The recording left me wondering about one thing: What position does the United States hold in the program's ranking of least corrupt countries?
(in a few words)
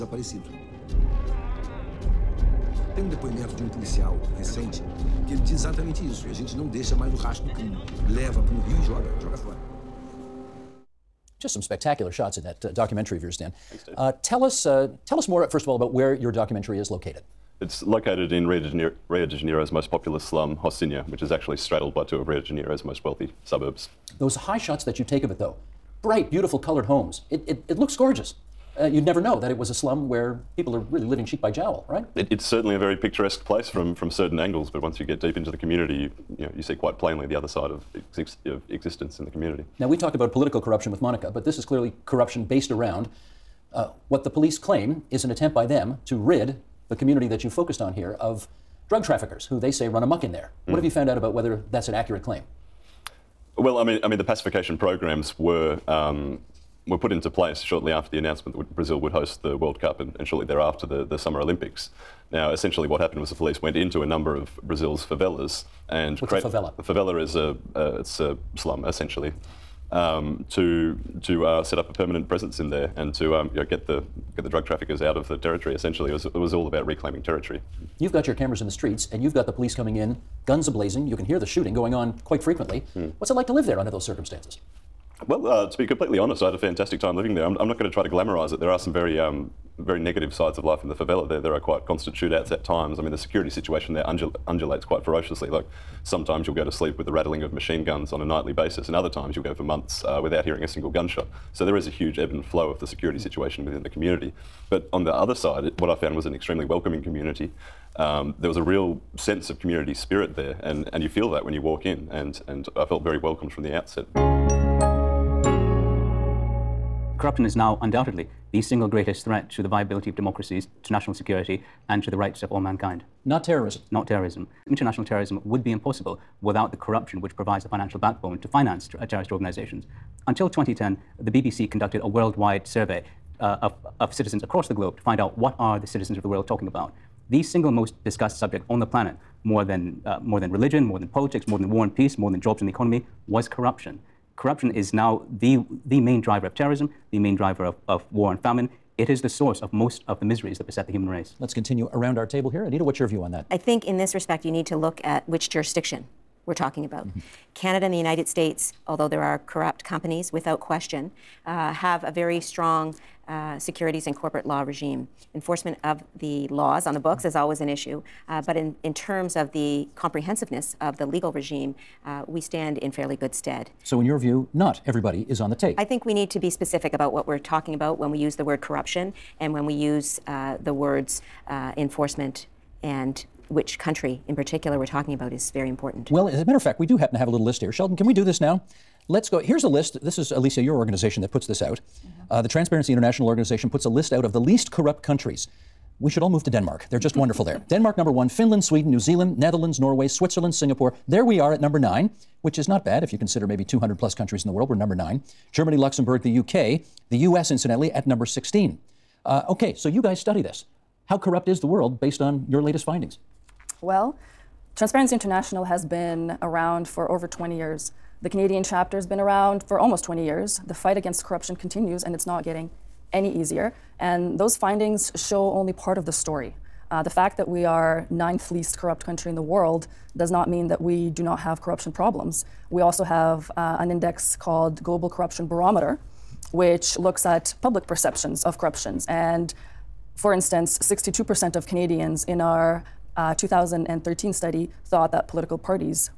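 16.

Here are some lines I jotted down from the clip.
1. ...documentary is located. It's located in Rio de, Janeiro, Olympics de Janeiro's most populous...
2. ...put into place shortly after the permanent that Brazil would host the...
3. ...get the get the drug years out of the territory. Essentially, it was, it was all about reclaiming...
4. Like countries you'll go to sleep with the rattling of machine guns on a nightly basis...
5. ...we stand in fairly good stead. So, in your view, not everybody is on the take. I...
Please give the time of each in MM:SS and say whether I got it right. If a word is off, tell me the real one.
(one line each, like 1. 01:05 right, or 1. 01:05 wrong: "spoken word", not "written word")
1. 00:16 wrong: "Rio", not "Olympics"
2. 00:56 wrong: "announcement", not "permanent"
3. 01:13 wrong: "traffickers", not "years"
4. 01:35 wrong: "sometimes", not "countries"
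5. 02:52 right.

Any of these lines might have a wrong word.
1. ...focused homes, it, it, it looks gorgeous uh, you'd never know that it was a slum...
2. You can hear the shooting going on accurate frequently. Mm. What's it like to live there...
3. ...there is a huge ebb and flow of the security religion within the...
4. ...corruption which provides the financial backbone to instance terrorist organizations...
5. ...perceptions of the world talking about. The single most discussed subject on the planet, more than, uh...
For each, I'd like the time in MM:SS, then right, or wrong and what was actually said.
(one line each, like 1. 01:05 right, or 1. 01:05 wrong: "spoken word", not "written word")
1. 00:26 wrong: "colored", not "focused"
2. 01:21 wrong: "quite", not "accurate"
3. 01:41 wrong: "situation", not "religion"
4. 02:06 wrong: "finance", not "instance"
5. 02:15 wrong: "citizens", not "perceptions".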